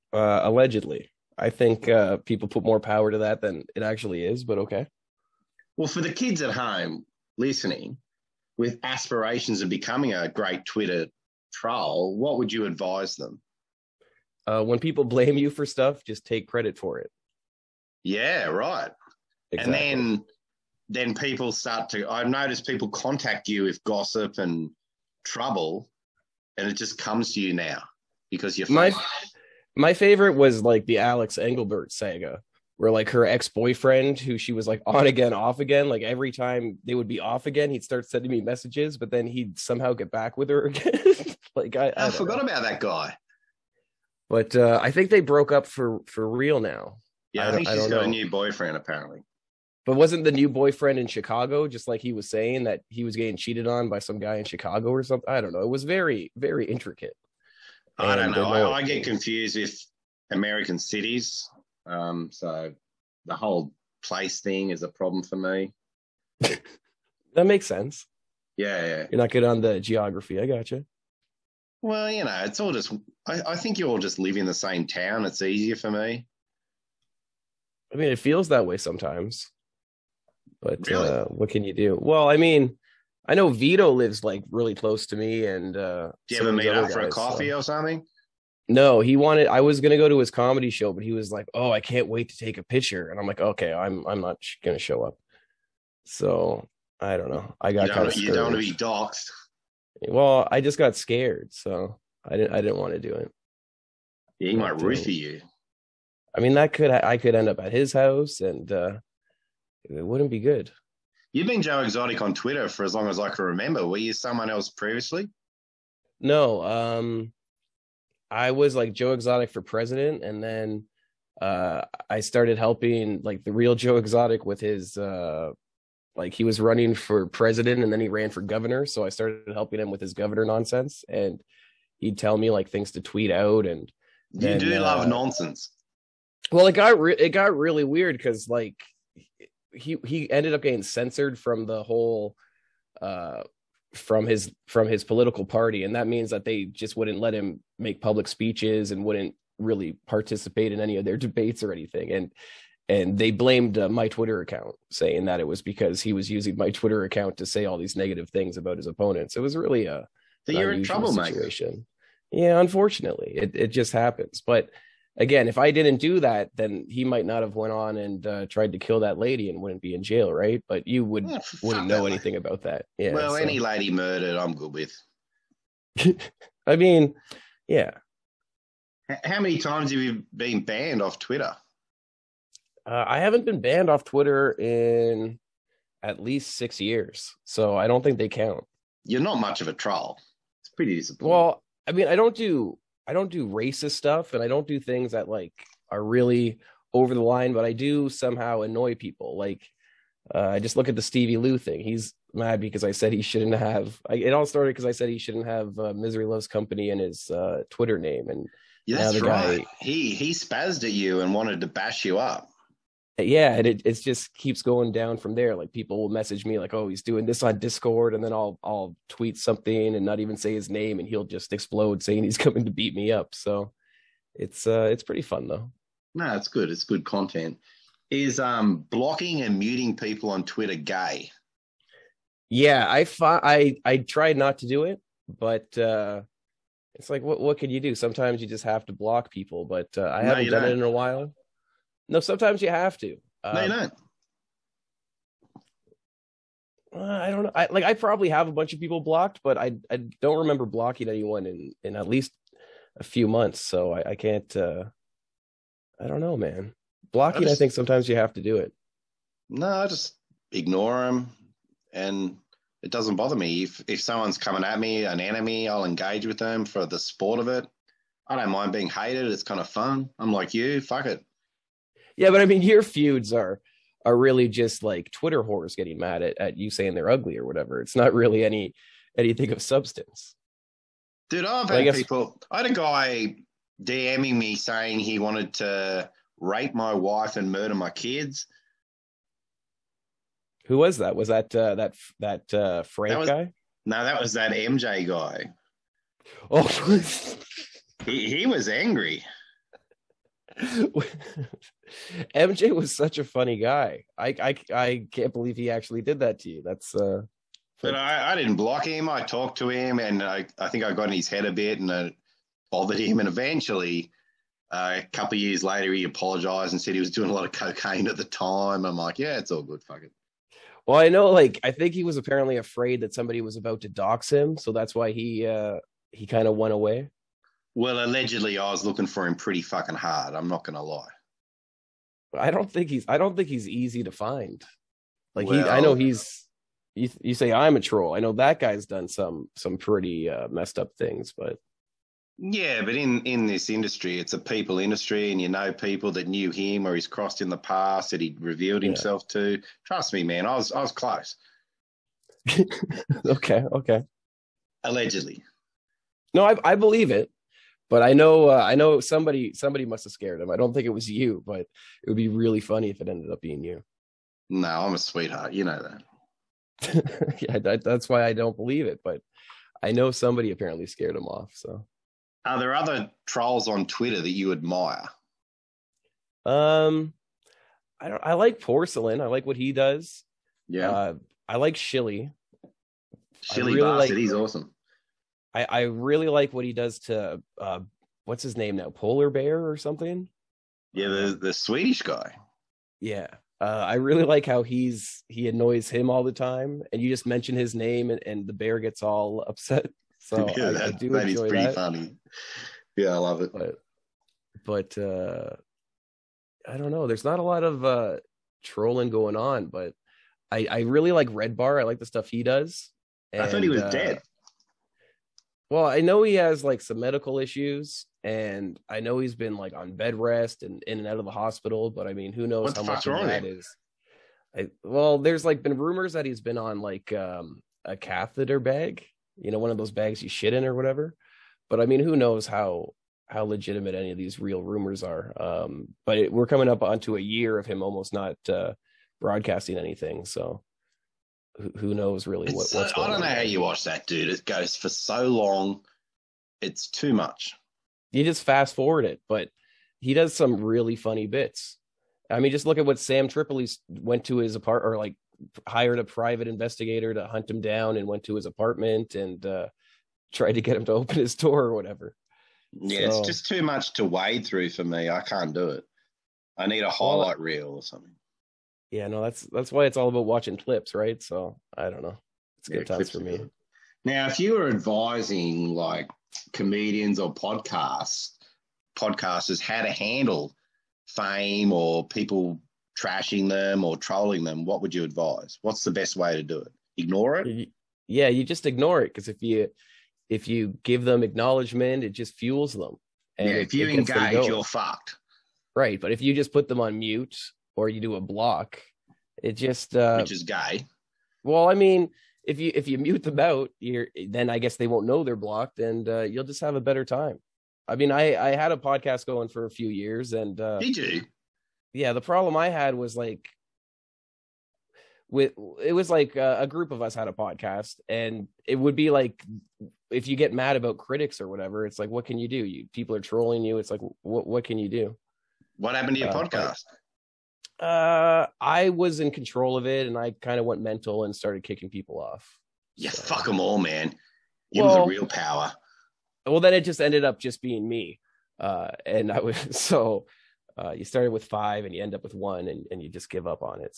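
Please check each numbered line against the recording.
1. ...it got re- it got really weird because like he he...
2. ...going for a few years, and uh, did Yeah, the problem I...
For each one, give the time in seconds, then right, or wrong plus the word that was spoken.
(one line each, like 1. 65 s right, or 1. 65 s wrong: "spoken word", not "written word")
1. 136 s right
2. 509 s right.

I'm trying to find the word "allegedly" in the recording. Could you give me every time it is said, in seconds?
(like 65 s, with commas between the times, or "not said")
0 s, 328 s, 354 s.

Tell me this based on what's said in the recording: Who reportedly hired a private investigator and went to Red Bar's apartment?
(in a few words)
Sam Tripoli.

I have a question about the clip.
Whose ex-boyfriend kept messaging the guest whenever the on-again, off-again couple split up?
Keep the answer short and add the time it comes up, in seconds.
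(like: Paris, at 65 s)
Alex Engelbert, at 30 s.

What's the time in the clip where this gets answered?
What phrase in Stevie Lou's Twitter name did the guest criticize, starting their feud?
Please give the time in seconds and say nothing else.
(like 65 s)
205 s.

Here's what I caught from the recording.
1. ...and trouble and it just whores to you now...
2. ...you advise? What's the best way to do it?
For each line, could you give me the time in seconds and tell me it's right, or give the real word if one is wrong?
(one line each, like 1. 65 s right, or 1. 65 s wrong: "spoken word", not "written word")
1. 24 s wrong: "comes", not "whores"
2. 484 s right.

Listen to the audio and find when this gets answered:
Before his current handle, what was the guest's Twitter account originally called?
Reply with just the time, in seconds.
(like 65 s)
118 s.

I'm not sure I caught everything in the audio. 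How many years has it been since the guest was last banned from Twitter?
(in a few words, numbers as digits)
6.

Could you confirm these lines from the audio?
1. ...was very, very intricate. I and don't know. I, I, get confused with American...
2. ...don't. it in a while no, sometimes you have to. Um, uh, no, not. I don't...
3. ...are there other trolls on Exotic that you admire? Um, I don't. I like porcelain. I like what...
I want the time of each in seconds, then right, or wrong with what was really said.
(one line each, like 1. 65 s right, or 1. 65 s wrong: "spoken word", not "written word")
1. 55 s right
2. 240 s right
3. 372 s wrong: "Twitter", not "Exotic".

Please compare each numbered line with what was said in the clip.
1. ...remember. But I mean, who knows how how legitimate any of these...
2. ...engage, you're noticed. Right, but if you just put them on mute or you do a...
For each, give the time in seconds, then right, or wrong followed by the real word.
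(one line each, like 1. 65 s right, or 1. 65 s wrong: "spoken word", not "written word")
1. 430 s wrong: "whatever", not "remember"
2. 493 s wrong: "fucked", not "noticed".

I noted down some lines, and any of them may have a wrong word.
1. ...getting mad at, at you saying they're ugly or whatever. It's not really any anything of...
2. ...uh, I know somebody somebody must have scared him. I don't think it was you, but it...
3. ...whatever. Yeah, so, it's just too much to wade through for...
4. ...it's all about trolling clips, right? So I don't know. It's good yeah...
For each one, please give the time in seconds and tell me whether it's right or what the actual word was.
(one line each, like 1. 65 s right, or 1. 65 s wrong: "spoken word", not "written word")
1. 275 s right
2. 358 s right
3. 461 s right
4. 469 s wrong: "watching", not "trolling".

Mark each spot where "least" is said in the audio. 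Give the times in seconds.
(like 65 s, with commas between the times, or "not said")
186 s, 252 s.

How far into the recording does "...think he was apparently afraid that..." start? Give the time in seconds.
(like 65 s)
321 s.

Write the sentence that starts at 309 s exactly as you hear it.
I talked to him, and I, I think I got in his head a bit, and I bothered him.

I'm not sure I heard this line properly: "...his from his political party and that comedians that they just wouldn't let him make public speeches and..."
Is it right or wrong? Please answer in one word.
wrong.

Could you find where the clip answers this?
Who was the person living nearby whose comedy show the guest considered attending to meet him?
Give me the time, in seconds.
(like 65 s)
83 s.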